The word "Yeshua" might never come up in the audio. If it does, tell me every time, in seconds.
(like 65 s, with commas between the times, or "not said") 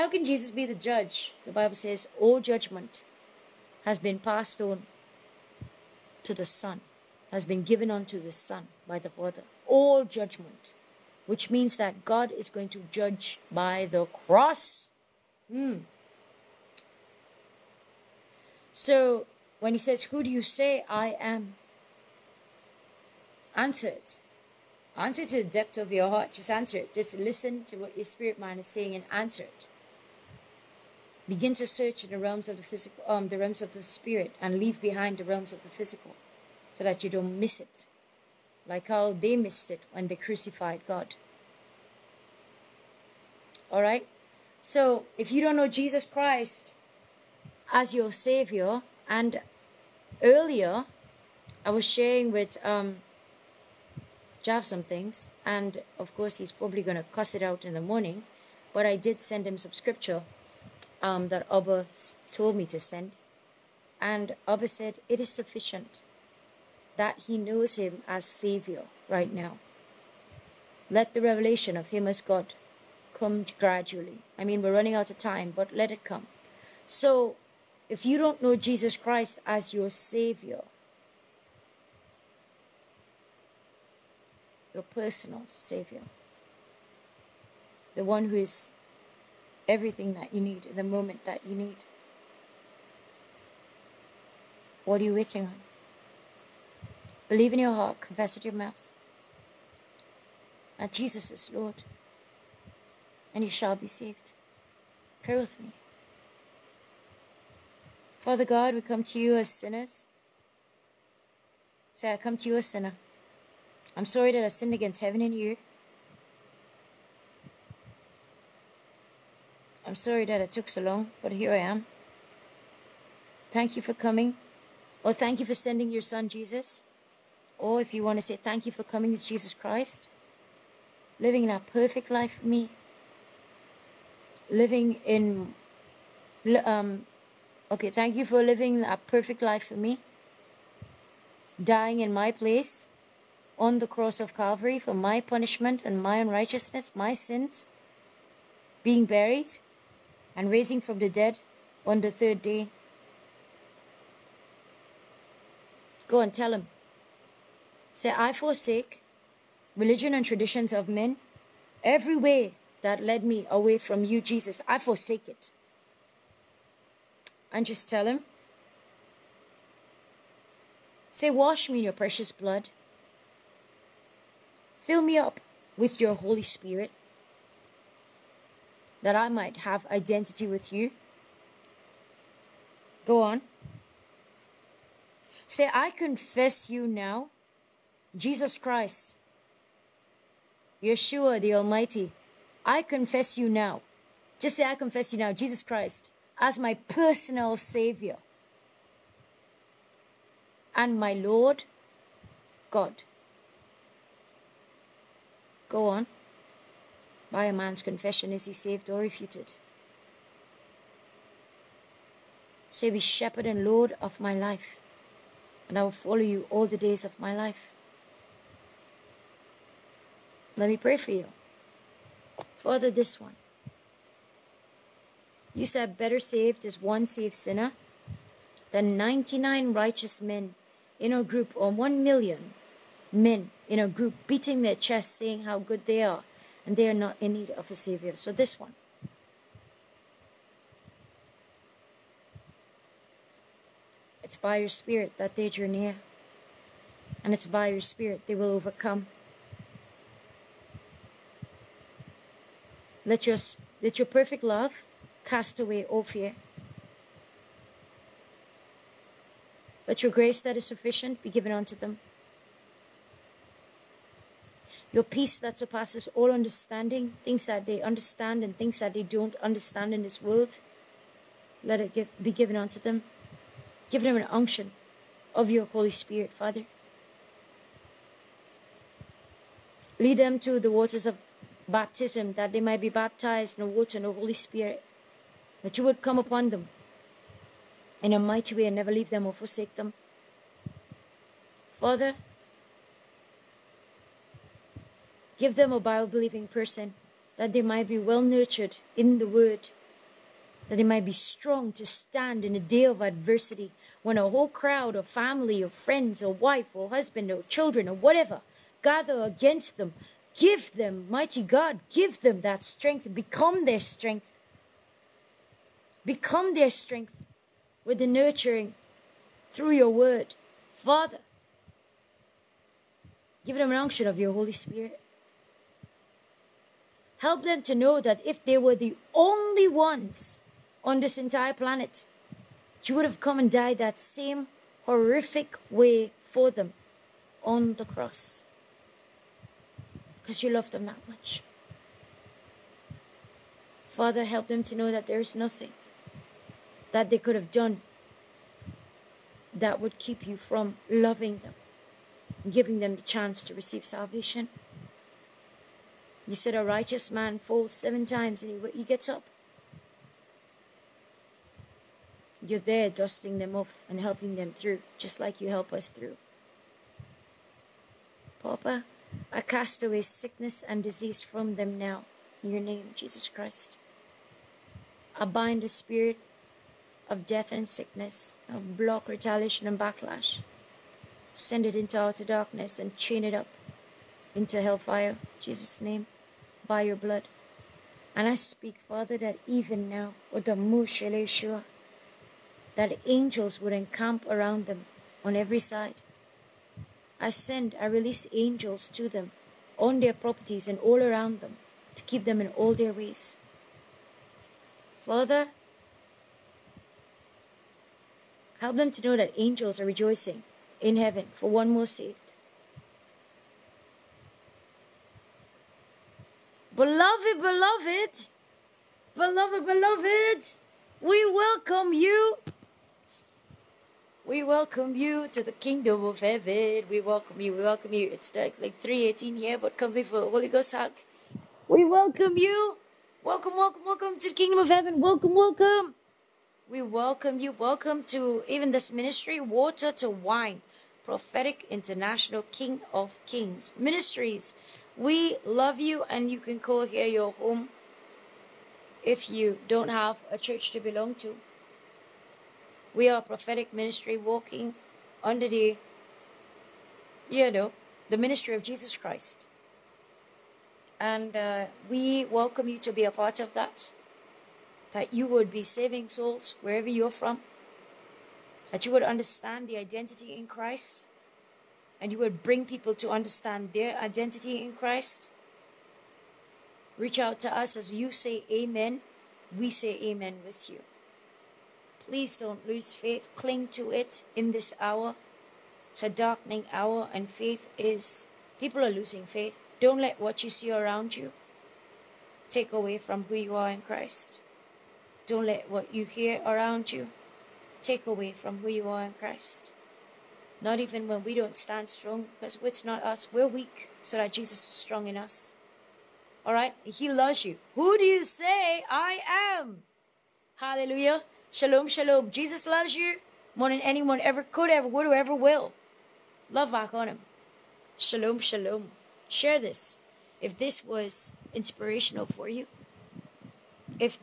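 190 s, 390 s.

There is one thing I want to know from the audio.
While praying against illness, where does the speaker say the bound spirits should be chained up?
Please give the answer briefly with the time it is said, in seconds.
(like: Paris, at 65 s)
hellfire, at 384 s.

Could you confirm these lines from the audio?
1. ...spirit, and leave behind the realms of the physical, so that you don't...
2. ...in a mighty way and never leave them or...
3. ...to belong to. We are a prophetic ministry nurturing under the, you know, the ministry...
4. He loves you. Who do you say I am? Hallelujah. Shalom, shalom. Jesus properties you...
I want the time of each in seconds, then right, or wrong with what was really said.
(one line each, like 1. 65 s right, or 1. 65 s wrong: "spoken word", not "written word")
1. 33 s right
2. 288 s right
3. 450 s wrong: "walking", not "nurturing"
4. 506 s wrong: "loves", not "properties".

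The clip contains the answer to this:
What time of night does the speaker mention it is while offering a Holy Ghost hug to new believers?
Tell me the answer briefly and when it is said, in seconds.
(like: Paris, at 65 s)
3:18, at 428 s.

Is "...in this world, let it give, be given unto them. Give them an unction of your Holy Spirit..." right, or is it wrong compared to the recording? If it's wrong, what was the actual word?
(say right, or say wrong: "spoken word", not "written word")
right.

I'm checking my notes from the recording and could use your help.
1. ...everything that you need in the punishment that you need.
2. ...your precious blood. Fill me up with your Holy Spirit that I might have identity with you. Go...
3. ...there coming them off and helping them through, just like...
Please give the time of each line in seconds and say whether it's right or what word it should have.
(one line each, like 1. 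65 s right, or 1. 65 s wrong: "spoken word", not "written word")
1. 89 s wrong: "moment", not "punishment"
2. 171 s right
3. 362 s wrong: "dusting", not "coming".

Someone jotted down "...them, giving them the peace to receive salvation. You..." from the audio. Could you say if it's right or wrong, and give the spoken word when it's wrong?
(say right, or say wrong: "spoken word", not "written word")
wrong: "chance", not "peace".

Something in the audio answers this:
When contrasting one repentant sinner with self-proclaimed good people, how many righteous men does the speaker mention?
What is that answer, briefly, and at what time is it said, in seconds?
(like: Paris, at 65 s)
99, at 228 s.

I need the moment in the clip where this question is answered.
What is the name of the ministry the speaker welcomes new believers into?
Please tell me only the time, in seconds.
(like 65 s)
439 s.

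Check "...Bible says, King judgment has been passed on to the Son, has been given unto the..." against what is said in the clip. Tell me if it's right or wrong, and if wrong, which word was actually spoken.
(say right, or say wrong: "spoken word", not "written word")
wrong: "All", not "King".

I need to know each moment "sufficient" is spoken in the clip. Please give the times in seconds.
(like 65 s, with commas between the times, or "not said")
65 s, 260 s.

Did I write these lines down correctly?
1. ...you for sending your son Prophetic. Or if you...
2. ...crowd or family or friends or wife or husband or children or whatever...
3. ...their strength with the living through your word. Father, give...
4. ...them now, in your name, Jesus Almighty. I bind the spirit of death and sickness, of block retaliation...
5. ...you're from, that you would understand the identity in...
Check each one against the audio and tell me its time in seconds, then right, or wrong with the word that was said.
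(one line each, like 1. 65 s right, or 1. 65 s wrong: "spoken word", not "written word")
1. 125 s wrong: "Jesus", not "Prophetic"
2. 304 s right
3. 316 s wrong: "nurturing", not "living"
4. 371 s wrong: "Christ", not "Almighty"
5. 466 s right.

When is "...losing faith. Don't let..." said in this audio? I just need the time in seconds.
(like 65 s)
489 s.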